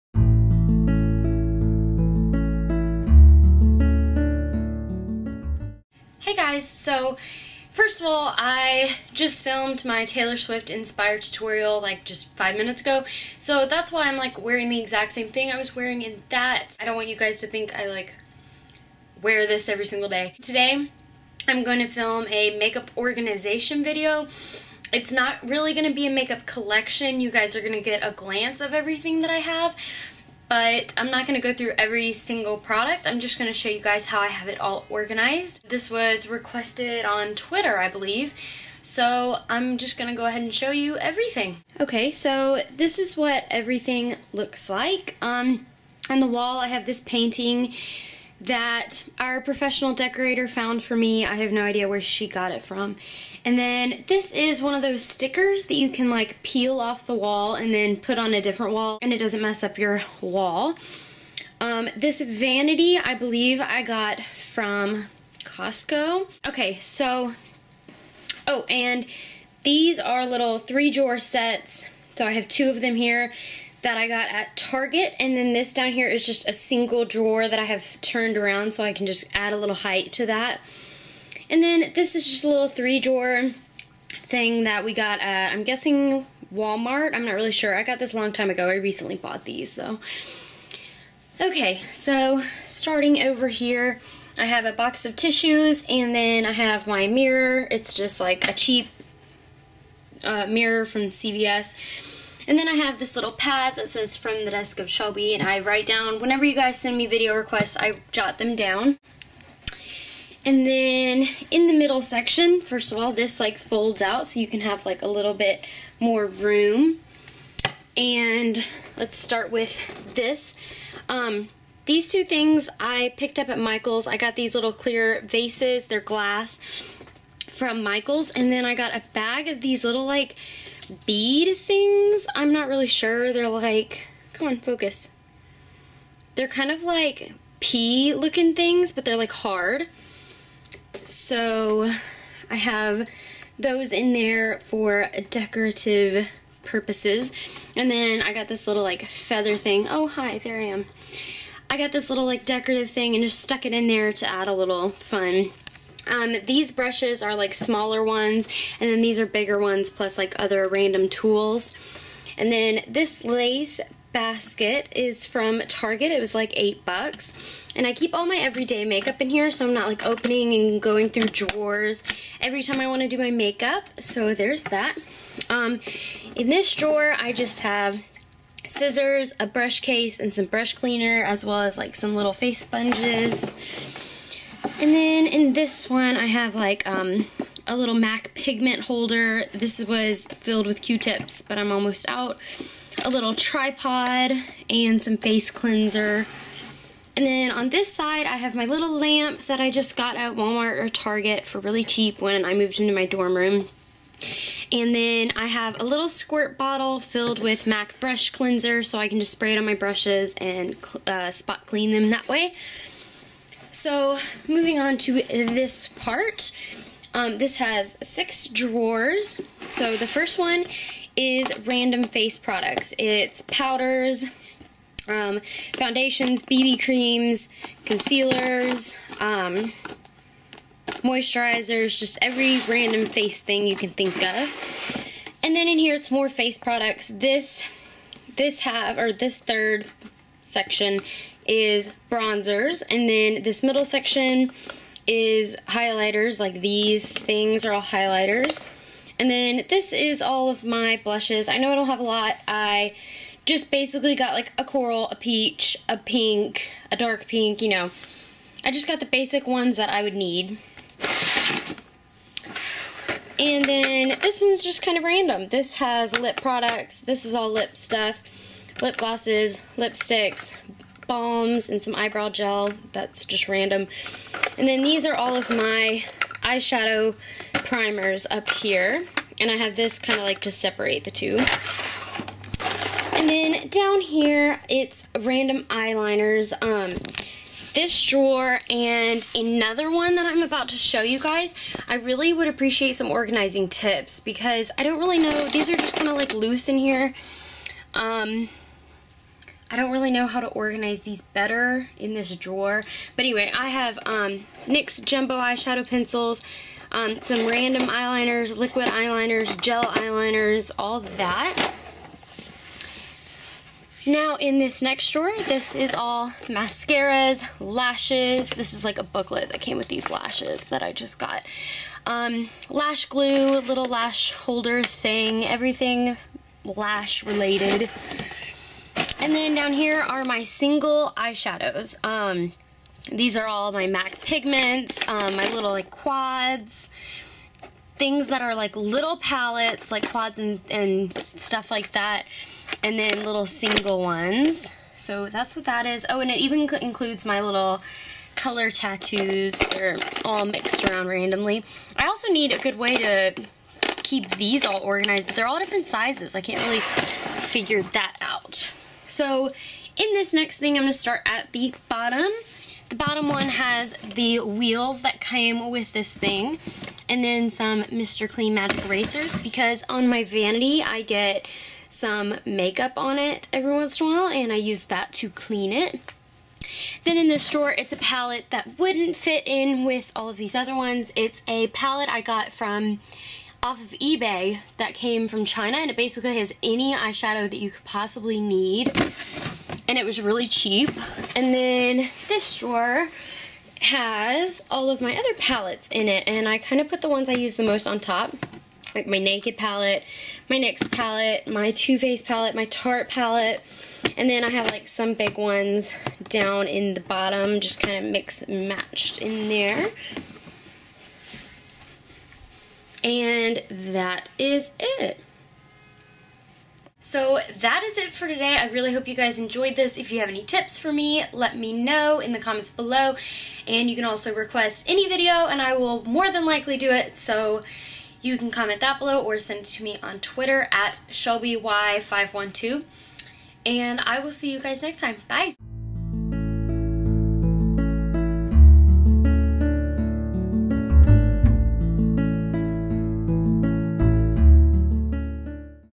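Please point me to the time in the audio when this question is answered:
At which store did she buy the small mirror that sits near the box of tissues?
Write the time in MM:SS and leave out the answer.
01:41.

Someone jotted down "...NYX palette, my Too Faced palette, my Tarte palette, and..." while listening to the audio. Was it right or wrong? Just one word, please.
right.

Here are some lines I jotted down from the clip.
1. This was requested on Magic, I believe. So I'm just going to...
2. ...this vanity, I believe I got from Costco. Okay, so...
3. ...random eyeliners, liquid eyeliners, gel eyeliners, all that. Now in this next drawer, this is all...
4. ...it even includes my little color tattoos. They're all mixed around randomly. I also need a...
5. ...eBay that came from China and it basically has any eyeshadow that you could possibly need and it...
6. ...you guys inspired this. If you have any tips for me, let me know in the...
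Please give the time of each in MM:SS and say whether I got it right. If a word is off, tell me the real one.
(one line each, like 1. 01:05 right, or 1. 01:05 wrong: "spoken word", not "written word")
1. 00:35 wrong: "Twitter", not "Magic"
2. 01:01 right
3. 05:07 right
4. 05:46 right
5. 06:23 right
6. 06:59 wrong: "enjoyed", not "inspired".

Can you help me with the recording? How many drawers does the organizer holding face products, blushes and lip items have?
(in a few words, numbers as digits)
6.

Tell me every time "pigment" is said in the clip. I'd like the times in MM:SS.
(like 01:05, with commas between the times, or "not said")
03:08, 05:34.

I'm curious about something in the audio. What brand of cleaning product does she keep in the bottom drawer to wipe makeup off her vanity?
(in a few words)
Mr. Clean Magic Erasers.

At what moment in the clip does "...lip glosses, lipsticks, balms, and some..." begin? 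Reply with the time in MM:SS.
04:28.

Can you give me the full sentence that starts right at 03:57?
This this half or this third section is bronzers, and then this middle section is highlighters, like these things are all highlighters.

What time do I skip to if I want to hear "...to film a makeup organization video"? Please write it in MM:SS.
00:21.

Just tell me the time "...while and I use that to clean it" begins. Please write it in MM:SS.
06:14.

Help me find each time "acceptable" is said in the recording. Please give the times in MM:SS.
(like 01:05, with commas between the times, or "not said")
not said.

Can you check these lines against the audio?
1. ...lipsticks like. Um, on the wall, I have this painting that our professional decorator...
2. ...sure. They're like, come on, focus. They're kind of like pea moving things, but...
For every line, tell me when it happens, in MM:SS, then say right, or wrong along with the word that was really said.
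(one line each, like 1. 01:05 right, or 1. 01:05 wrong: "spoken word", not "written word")
1. 00:44 wrong: "looks", not "lipsticks"
2. 02:12 wrong: "looking", not "moving".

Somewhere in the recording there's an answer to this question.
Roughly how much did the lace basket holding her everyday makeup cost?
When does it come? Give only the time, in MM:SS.
02:46.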